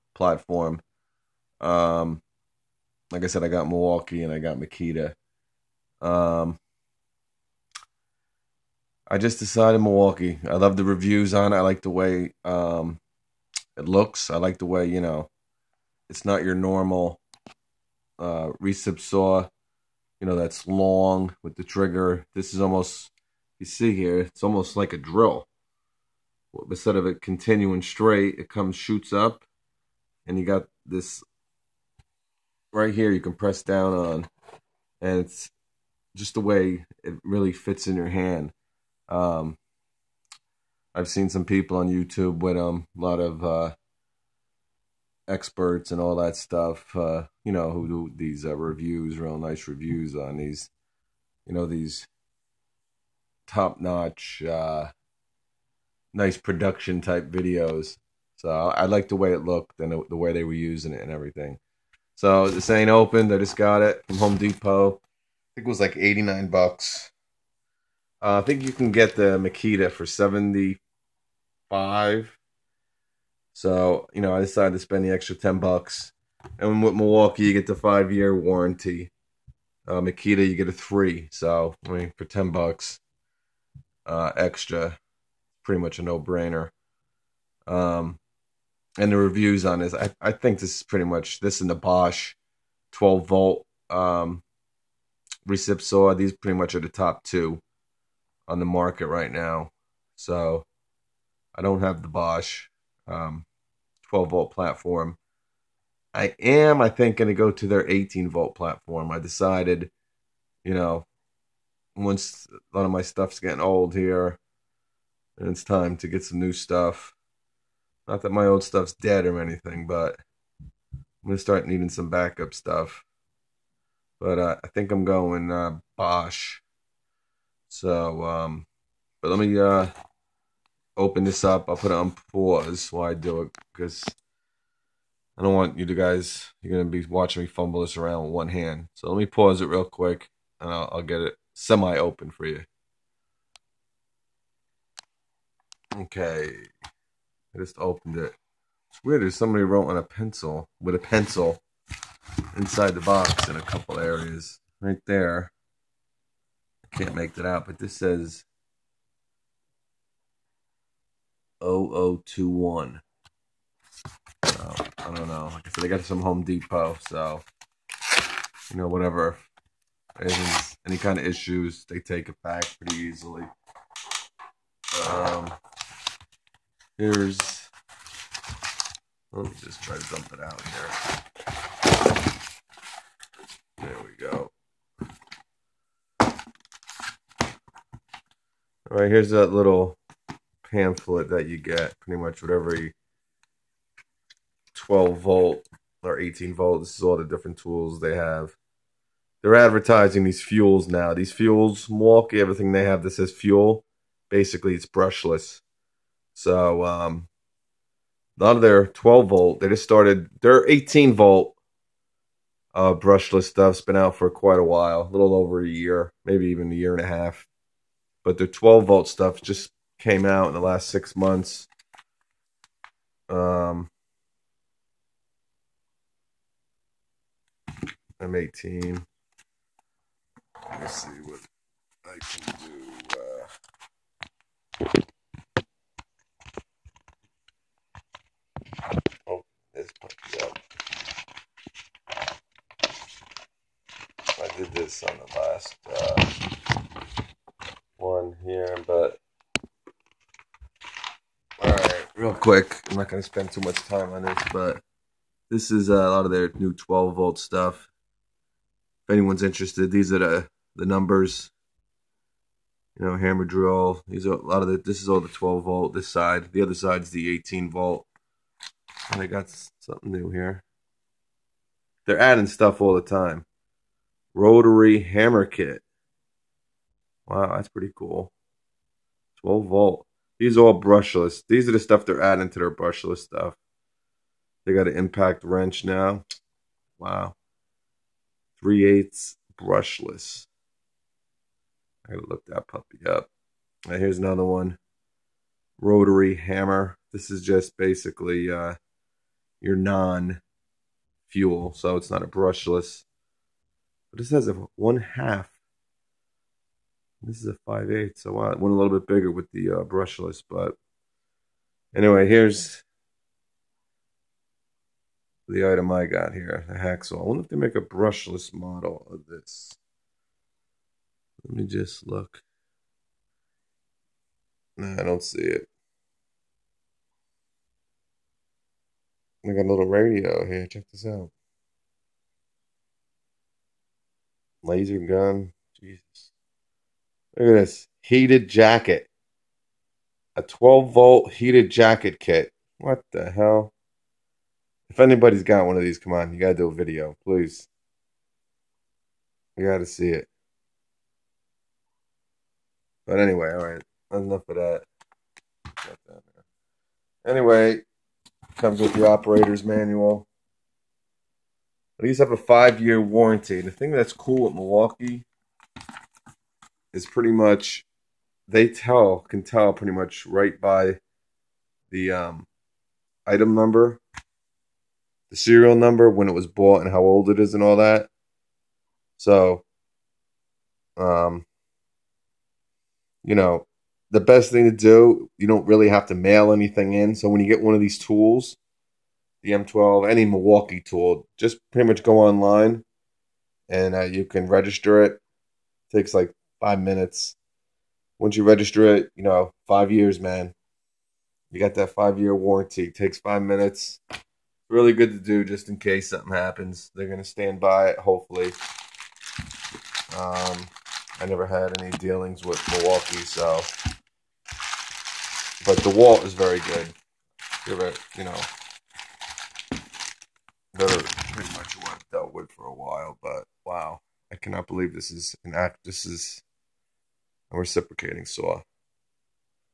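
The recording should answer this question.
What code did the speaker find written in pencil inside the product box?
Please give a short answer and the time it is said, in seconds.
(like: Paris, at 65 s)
0021, at 161 s.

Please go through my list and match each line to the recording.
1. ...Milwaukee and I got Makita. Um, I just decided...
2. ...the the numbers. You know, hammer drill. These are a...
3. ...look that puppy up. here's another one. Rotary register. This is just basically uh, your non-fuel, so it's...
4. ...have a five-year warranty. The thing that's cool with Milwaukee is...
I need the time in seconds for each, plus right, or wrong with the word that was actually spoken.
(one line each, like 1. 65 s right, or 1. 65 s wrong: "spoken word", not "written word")
1. 3 s right
2. 260 s right
3. 292 s wrong: "hammer", not "register"
4. 362 s right.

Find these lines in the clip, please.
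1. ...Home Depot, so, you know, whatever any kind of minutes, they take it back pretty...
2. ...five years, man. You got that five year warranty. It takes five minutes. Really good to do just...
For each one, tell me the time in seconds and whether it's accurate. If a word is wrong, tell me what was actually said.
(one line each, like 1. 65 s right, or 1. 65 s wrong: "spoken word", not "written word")
1. 166 s wrong: "issues", not "minutes"
2. 399 s right.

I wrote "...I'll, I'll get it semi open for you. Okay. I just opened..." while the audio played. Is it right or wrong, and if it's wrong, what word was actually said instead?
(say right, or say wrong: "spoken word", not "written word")
right.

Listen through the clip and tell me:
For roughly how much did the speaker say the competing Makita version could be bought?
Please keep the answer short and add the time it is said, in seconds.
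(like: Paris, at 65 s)
75, at 70 s.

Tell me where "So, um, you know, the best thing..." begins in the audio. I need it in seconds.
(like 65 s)
379 s.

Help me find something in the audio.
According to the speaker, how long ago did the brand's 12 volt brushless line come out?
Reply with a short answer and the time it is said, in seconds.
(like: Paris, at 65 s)
last six months, at 220 s.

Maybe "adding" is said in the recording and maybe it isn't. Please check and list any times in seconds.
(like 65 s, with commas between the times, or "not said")
272 s, 282 s.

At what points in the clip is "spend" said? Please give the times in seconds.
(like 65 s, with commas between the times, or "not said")
74 s, 253 s.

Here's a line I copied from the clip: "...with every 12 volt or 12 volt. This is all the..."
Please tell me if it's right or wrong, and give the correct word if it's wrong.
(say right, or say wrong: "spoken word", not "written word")
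wrong: "18", not "12".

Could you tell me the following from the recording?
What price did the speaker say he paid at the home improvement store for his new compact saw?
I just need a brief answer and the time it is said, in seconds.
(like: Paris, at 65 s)
89 bucks, at 65 s.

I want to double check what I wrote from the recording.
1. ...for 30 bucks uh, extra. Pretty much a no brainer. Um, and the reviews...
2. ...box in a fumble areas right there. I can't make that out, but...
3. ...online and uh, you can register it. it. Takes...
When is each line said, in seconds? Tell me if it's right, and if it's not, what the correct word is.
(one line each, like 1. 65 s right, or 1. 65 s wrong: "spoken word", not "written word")
1. 82 s wrong: "10", not "30"
2. 152 s wrong: "couple", not "fumble"
3. 392 s right.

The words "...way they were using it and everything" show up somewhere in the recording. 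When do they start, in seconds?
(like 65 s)
60 s.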